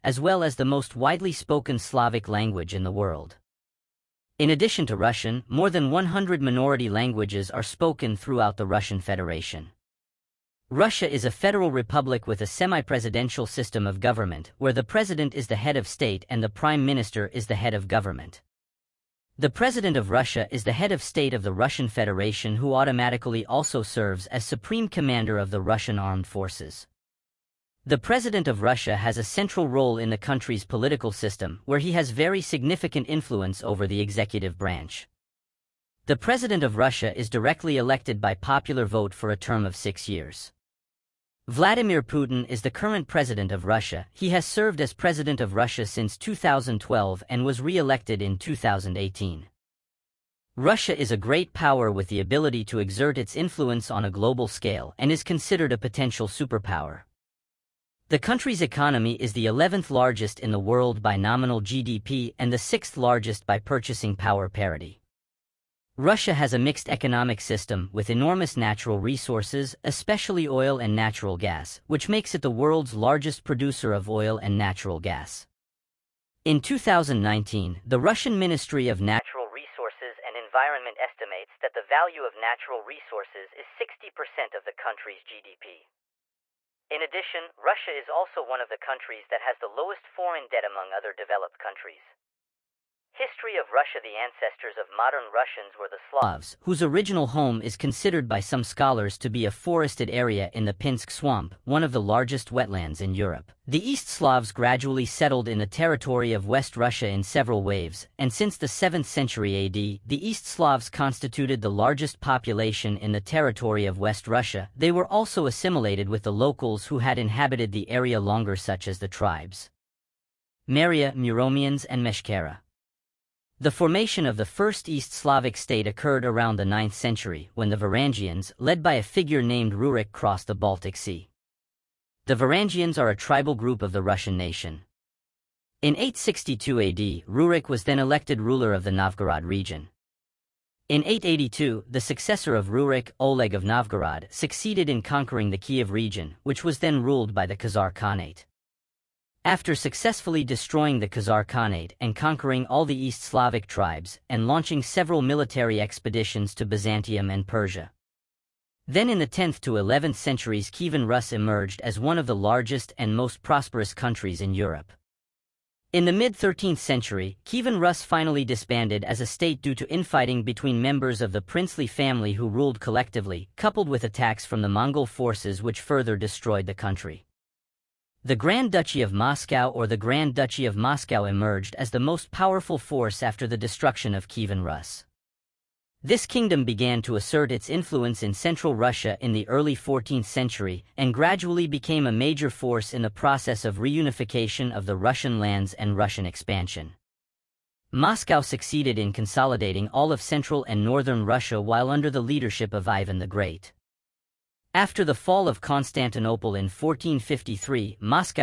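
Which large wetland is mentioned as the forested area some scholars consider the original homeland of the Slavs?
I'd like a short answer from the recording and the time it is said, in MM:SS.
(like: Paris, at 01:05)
Pinsk Swamp, at 01:40.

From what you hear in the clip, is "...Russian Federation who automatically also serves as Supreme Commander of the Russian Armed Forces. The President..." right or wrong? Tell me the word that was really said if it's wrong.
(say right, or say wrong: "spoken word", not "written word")
right.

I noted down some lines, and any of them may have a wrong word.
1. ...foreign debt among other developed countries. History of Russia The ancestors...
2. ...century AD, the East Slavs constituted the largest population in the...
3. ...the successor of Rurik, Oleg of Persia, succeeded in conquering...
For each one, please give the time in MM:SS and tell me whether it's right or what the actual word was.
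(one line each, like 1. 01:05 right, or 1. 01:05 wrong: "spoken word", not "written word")
1. 01:30 right
2. 01:49 right
3. 02:21 wrong: "Novgorod", not "Persia".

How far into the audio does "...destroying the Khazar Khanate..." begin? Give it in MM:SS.
02:30.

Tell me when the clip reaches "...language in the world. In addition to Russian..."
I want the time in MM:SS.
00:02.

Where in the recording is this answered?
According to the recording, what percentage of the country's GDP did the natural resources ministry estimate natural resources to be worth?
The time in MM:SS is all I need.
01:23.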